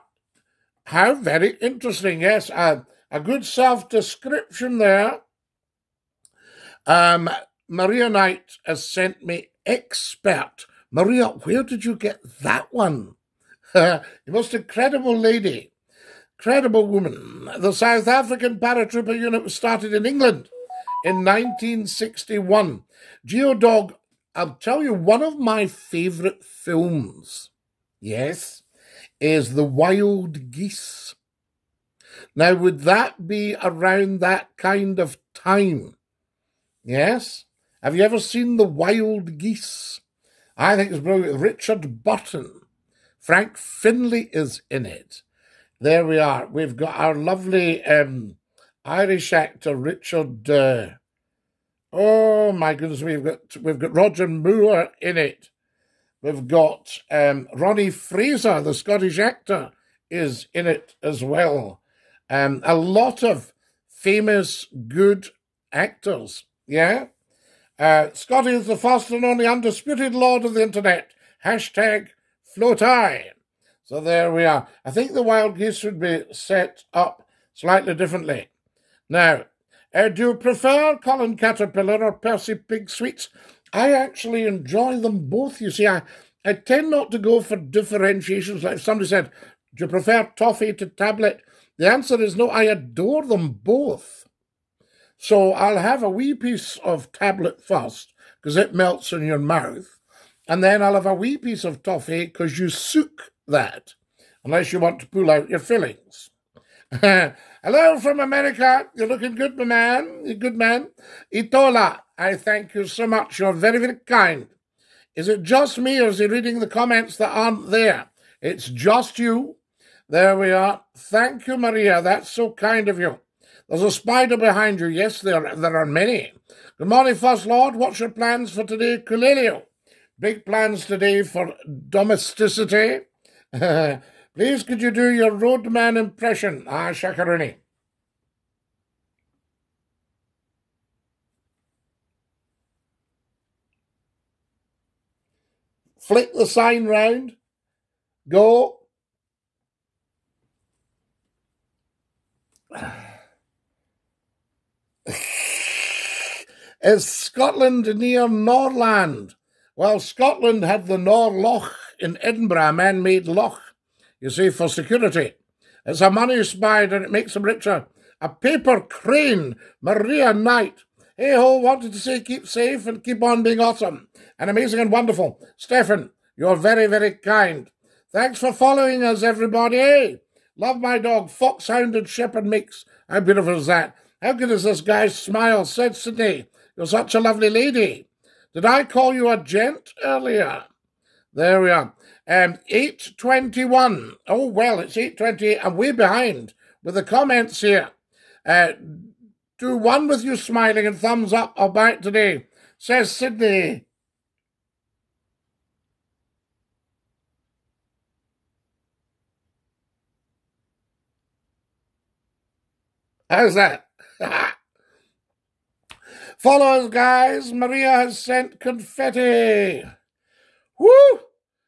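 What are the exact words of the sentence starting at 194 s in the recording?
Oh, well, it's 8.28 and we're behind with the comments here.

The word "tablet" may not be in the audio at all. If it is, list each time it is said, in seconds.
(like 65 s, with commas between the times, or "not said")
90 s, 97 s.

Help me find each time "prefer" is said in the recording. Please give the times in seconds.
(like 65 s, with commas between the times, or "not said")
80 s, 89 s.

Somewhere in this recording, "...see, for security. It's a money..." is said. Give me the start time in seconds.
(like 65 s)
164 s.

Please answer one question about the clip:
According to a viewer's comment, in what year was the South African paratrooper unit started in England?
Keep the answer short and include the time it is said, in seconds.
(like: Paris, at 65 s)
1961, at 21 s.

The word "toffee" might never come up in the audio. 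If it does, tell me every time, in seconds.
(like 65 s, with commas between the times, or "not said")
90 s, 101 s.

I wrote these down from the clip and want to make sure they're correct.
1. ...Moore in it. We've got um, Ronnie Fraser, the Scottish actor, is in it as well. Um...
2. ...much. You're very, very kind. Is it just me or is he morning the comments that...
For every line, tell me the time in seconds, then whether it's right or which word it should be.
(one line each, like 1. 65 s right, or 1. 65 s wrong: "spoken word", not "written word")
1. 54 s right
2. 113 s wrong: "reading", not "morning".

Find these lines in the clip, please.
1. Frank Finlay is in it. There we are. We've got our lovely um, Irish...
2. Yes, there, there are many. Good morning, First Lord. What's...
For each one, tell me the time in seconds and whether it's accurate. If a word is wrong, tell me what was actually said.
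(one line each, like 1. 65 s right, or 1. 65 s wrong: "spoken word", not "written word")
1. 43 s right
2. 124 s right.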